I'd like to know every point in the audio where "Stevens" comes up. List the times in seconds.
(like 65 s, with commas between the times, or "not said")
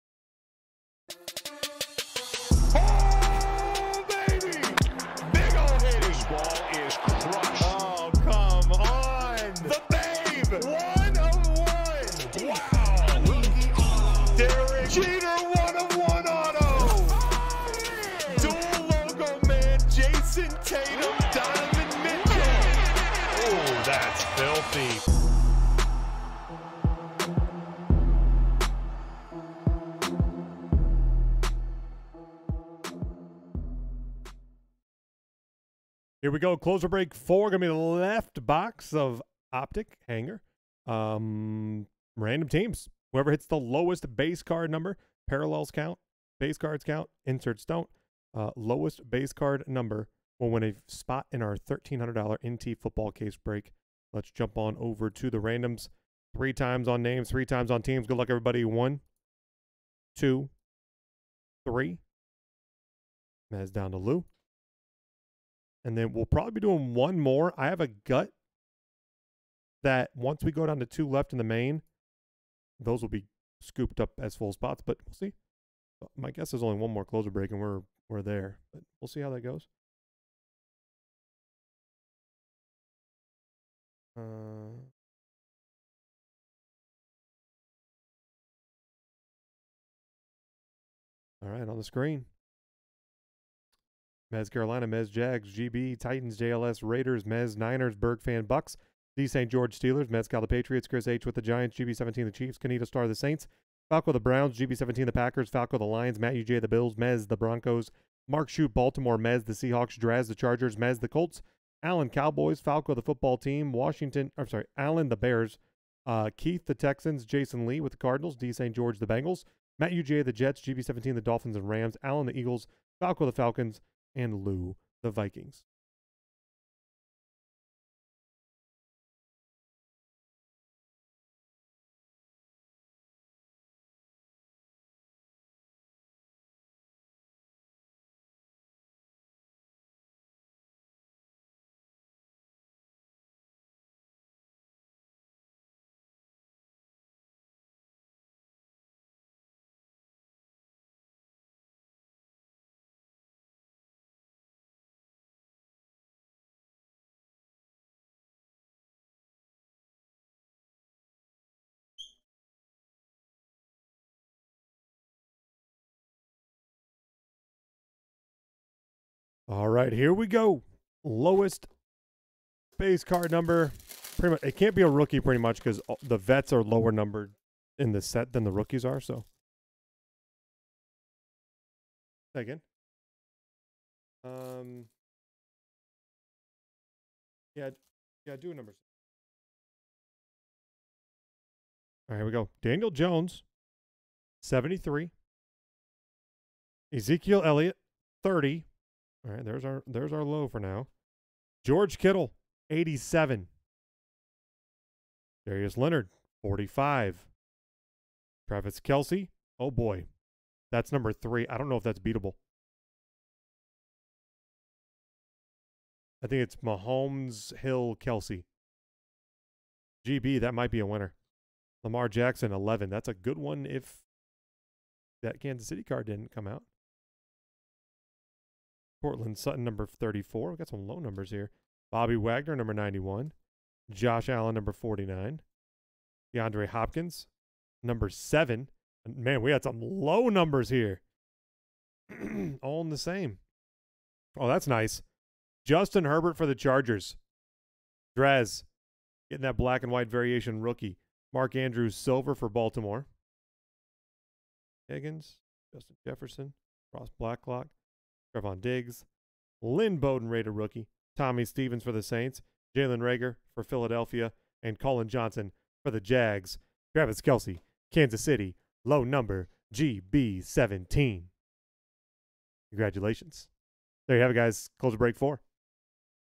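261 s.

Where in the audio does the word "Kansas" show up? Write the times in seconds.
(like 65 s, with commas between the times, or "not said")
225 s, 267 s.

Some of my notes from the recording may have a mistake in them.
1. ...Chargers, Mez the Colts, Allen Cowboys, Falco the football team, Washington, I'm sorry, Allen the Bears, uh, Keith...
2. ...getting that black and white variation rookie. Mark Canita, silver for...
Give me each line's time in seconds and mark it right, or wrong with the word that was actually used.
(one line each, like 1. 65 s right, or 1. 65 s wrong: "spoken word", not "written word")
1. 110 s right
2. 249 s wrong: "Andrews", not "Canita".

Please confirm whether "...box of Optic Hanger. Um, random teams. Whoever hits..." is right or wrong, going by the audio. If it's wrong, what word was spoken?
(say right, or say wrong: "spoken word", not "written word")
right.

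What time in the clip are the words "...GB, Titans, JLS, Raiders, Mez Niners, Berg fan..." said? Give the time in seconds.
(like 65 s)
95 s.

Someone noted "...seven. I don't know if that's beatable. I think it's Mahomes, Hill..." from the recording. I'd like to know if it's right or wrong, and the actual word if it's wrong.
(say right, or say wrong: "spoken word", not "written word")
wrong: "three", not "seven".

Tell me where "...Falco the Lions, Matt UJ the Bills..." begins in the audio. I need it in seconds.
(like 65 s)
105 s.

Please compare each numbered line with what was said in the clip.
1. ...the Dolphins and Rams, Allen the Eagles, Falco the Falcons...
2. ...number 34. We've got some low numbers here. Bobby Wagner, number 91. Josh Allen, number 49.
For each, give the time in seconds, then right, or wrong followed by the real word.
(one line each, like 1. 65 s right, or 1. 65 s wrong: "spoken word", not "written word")
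1. 121 s right
2. 229 s right.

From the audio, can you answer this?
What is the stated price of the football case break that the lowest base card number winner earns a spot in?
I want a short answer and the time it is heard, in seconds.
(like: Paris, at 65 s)
$1,300, at 51 s.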